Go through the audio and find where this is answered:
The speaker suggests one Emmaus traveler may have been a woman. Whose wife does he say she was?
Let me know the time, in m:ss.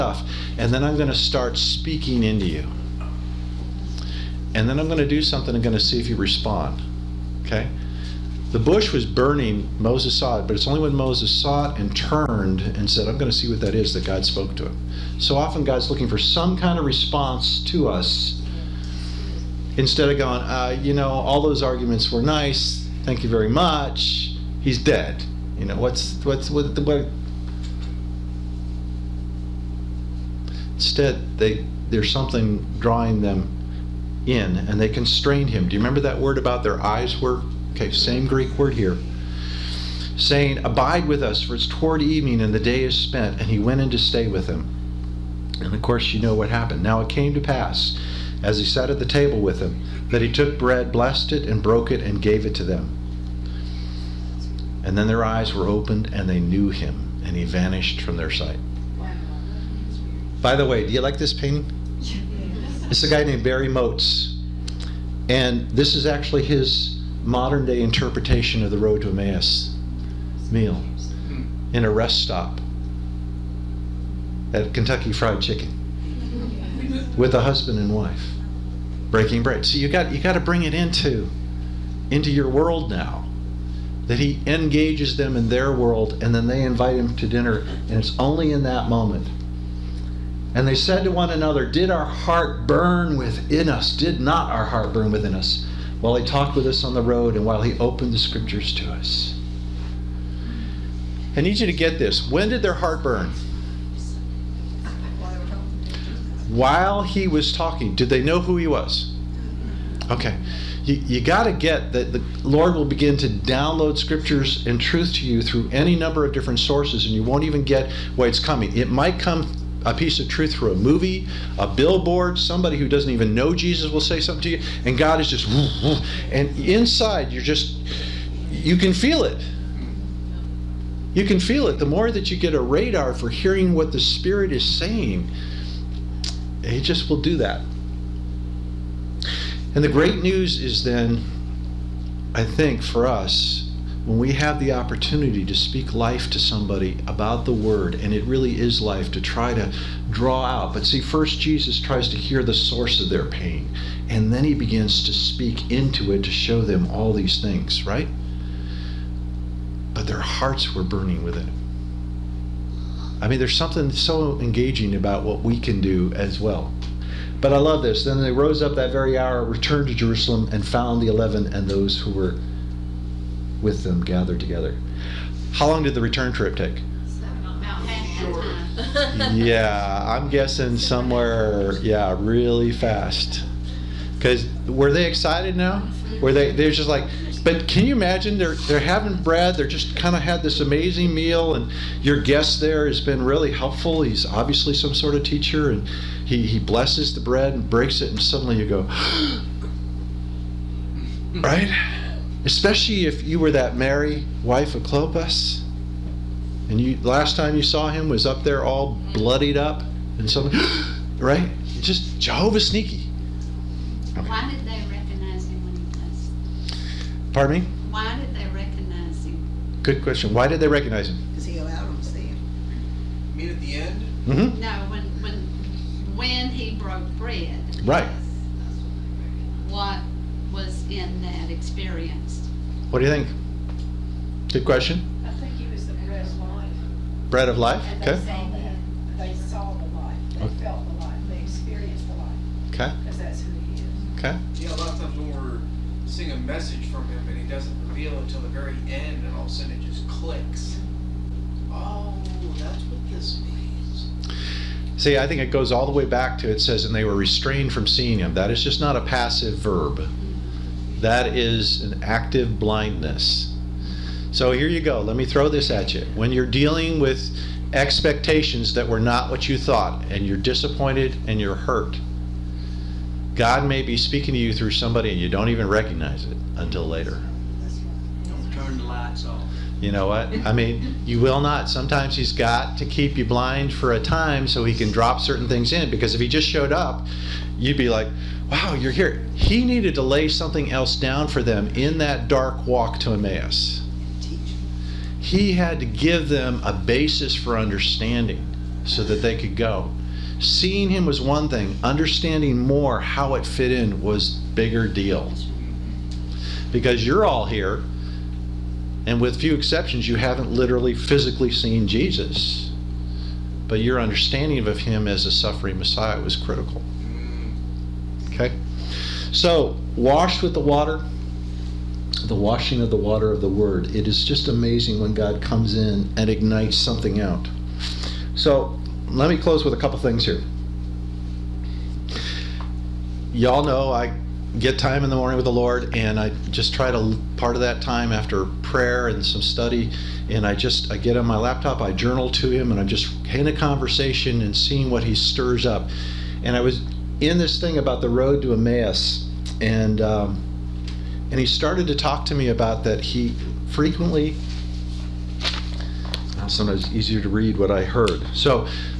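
3:24.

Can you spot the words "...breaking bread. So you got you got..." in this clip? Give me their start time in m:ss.
1:19.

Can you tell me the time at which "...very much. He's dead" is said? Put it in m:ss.
0:23.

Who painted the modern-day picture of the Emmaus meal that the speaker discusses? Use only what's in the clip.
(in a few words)
Barry Motz.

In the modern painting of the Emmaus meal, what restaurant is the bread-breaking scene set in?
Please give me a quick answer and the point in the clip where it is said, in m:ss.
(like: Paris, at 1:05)
Kentucky Fried Chicken, at 1:14.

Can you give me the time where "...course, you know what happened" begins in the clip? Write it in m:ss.
0:45.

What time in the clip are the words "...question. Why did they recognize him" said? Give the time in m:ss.
3:40.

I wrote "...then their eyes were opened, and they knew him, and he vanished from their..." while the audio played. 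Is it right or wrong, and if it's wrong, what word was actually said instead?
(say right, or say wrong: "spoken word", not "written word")
right.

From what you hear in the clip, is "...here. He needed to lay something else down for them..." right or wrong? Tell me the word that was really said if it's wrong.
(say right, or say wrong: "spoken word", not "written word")
right.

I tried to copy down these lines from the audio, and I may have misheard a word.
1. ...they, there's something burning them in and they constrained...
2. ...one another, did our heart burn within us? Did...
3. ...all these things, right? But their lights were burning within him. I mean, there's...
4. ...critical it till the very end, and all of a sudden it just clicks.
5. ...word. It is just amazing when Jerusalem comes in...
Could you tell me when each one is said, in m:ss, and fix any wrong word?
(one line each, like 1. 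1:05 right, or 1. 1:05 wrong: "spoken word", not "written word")
1. 0:31 wrong: "drawing", not "burning"
2. 1:31 right
3. 2:36 wrong: "hearts", not "lights"
4. 4:07 wrong: "reveal", not "critical"
5. 5:23 wrong: "God", not "Jerusalem".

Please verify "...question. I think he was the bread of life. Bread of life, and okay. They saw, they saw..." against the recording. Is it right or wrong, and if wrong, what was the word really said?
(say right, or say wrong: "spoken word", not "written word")
right.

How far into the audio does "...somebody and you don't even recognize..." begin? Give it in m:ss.
4:34.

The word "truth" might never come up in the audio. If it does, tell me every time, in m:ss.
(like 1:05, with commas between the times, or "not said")
1:54, 2:00.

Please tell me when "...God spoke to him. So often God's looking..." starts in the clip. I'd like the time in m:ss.
0:14.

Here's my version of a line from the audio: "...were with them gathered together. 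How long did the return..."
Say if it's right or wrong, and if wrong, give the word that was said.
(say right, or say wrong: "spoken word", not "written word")
right.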